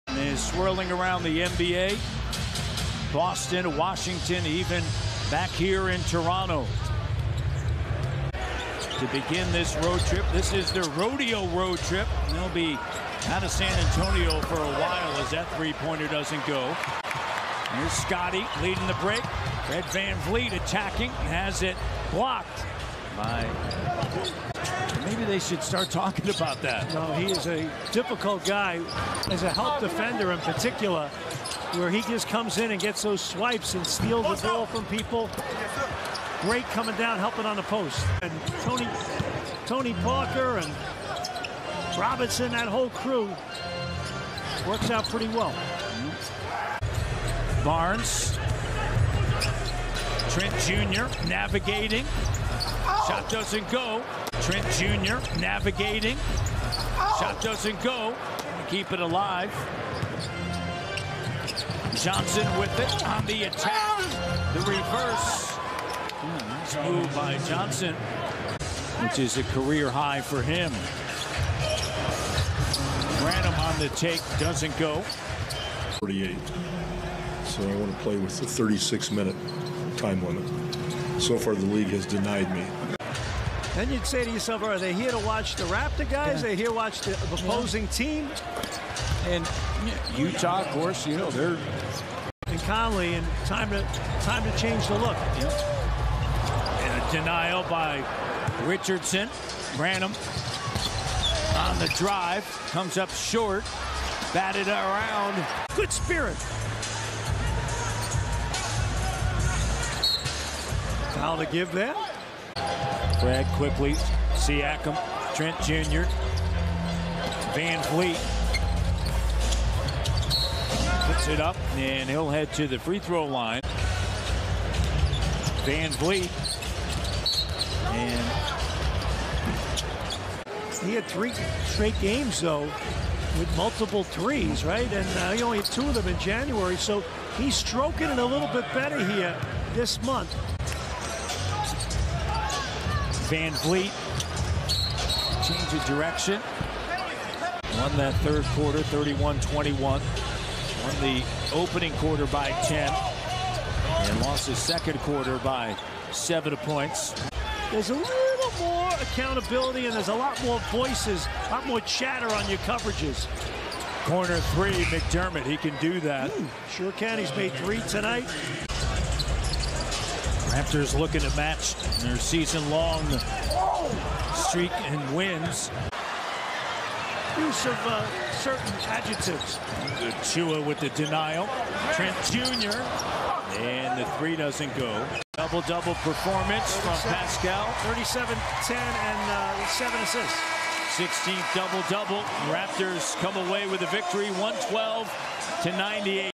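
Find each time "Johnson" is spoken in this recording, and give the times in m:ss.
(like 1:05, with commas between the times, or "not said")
1:01, 1:07.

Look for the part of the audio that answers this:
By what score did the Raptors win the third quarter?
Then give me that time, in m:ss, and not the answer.
2:28.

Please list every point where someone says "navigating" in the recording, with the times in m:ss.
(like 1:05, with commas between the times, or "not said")
0:51, 0:55.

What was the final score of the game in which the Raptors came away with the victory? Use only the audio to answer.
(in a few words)
112 to 98.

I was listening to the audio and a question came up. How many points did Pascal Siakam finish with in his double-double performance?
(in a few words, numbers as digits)
37.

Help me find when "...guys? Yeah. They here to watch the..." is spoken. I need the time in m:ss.
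1:26.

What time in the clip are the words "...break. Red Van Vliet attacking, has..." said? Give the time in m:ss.
0:19.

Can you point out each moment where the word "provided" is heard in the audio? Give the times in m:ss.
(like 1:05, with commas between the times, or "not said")
not said.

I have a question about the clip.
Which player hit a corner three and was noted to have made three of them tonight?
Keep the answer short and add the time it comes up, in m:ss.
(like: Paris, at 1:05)
McDermott, at 2:44.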